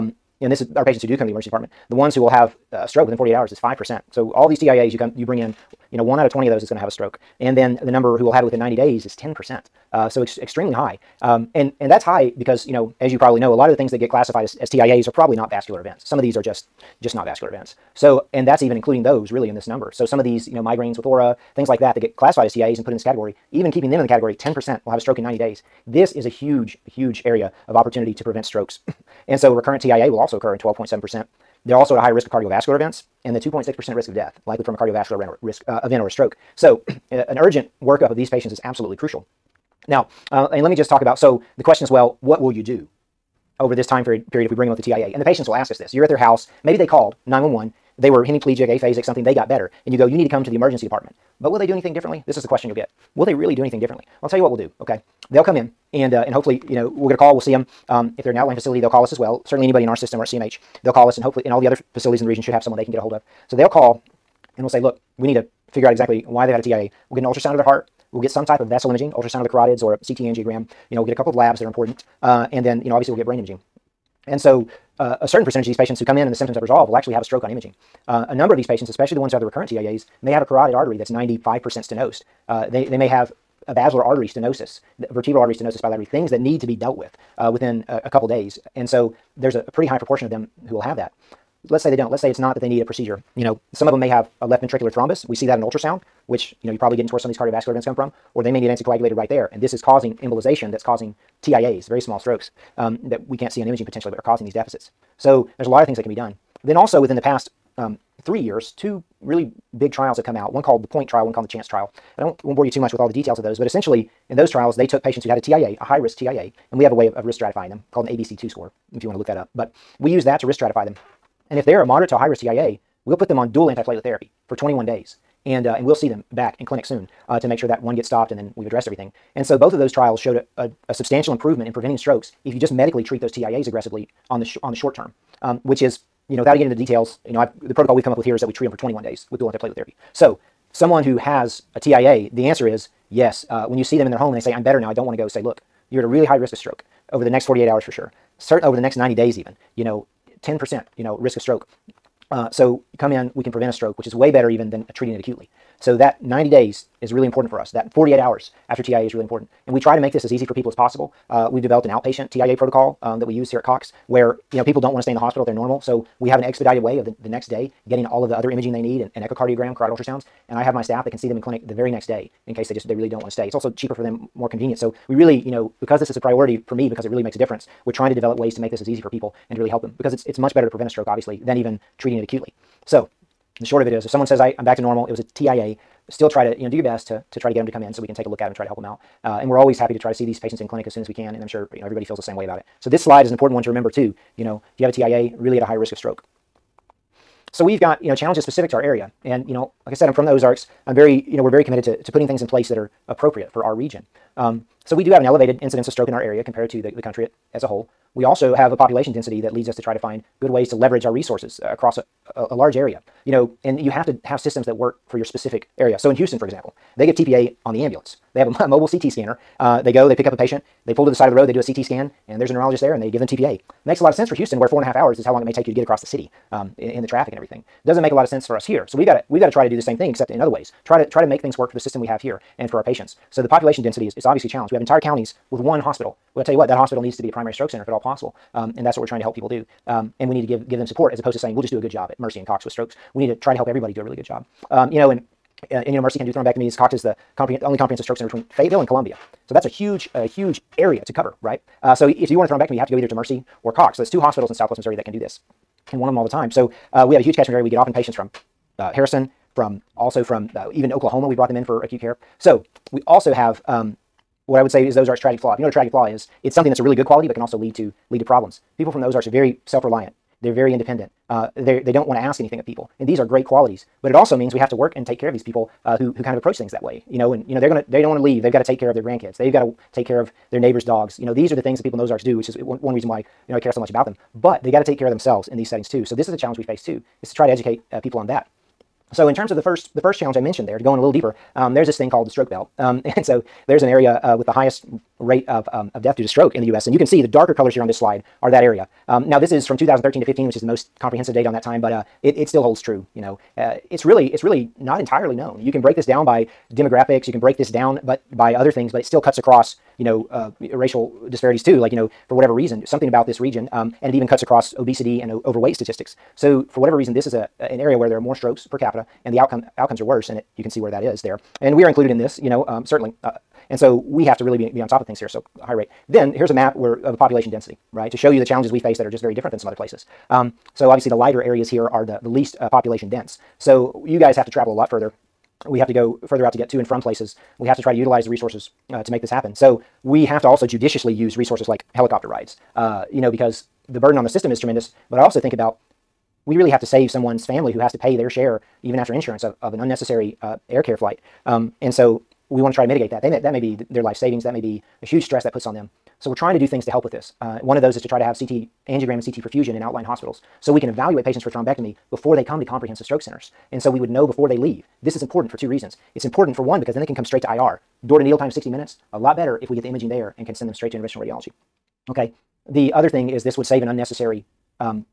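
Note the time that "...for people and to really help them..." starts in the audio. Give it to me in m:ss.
2:59.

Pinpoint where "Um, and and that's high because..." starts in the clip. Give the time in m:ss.
0:11.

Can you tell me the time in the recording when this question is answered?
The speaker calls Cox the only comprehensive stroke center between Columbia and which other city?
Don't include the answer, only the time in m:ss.
4:08.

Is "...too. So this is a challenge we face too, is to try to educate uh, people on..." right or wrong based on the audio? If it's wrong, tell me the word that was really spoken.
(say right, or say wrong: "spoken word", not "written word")
right.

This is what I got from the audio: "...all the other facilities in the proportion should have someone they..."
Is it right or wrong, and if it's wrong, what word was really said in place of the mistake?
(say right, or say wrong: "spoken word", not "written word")
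wrong: "region", not "proportion".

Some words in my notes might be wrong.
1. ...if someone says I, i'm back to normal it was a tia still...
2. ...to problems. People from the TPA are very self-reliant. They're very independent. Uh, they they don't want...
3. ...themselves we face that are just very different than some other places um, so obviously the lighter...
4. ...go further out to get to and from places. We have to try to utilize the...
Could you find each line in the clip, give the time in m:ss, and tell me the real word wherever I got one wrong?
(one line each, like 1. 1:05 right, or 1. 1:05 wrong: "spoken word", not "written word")
1. 3:04 right
2. 4:28 wrong: "Ozarks", not "TPA"
3. 5:28 wrong: "challenges", not "themselves"
4. 5:35 right.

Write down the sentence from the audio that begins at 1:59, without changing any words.
But we use that to risk stratify them.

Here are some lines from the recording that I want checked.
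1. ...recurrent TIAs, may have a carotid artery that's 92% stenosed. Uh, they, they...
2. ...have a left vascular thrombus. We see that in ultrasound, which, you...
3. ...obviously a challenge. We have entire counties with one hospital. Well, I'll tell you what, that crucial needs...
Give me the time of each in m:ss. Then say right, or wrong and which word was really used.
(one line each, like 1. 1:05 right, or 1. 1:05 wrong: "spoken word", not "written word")
1. 1:19 wrong: "95", not "92"
2. 1:34 wrong: "ventricular", not "vascular"
3. 3:54 wrong: "hospital", not "crucial".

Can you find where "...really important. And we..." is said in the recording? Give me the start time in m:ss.
2:39.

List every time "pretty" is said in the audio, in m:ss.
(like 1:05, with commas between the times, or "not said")
1:29.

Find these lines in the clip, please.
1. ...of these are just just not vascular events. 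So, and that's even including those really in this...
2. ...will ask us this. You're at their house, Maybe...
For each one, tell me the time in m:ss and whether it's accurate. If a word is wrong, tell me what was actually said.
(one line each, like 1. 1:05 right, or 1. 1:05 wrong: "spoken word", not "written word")
1. 0:16 right
2. 0:45 right.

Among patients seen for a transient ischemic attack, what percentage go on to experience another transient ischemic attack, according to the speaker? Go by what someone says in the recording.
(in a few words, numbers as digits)
12.7%.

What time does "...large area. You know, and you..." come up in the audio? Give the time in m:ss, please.
3:32.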